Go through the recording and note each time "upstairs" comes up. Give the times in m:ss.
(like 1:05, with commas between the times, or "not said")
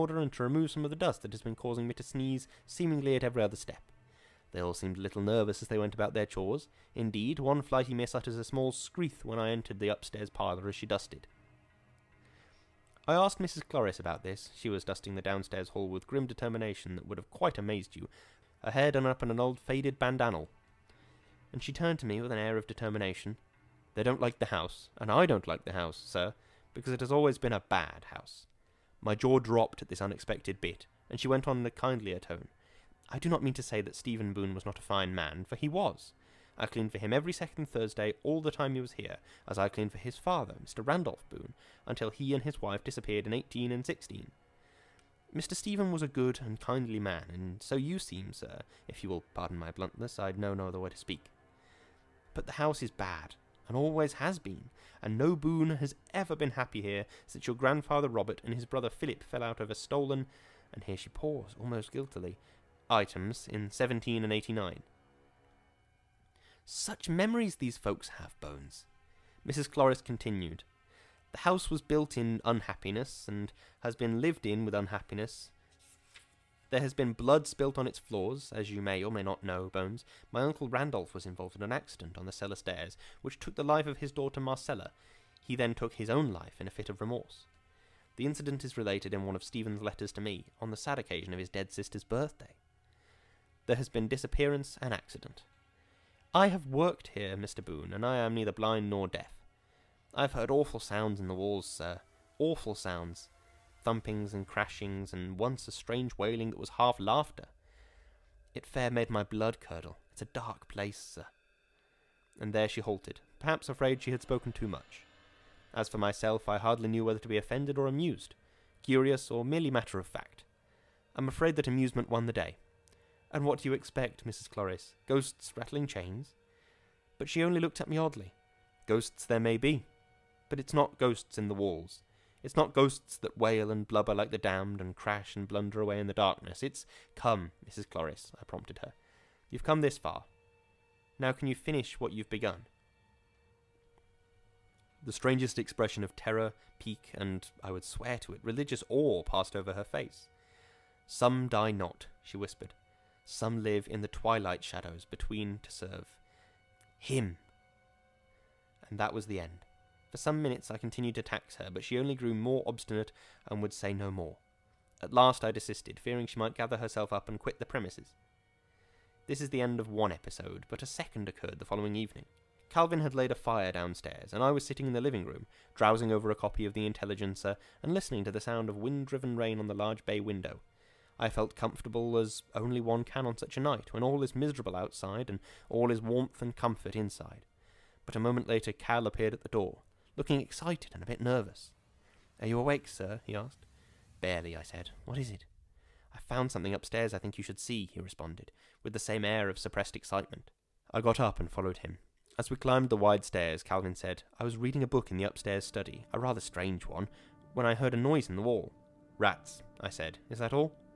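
0:09, 3:16, 3:25.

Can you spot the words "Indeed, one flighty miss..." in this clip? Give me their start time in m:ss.
0:06.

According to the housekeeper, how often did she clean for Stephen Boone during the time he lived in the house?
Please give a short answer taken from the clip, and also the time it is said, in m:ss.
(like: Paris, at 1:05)
every second Thursday, at 0:37.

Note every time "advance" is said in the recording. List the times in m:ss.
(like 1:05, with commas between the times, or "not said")
not said.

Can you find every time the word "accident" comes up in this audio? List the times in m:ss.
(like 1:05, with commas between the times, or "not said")
1:21, 1:34.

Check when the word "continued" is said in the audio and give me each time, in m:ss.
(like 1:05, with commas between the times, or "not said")
1:10, 2:40.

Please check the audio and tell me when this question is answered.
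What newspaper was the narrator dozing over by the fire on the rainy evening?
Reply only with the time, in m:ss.
2:56.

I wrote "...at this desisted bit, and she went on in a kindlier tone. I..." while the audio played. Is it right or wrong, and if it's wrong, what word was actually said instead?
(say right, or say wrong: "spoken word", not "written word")
wrong: "unexpected", not "desisted".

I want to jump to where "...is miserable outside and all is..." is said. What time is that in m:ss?
3:04.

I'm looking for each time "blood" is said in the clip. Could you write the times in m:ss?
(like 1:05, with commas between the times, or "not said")
1:17, 1:49.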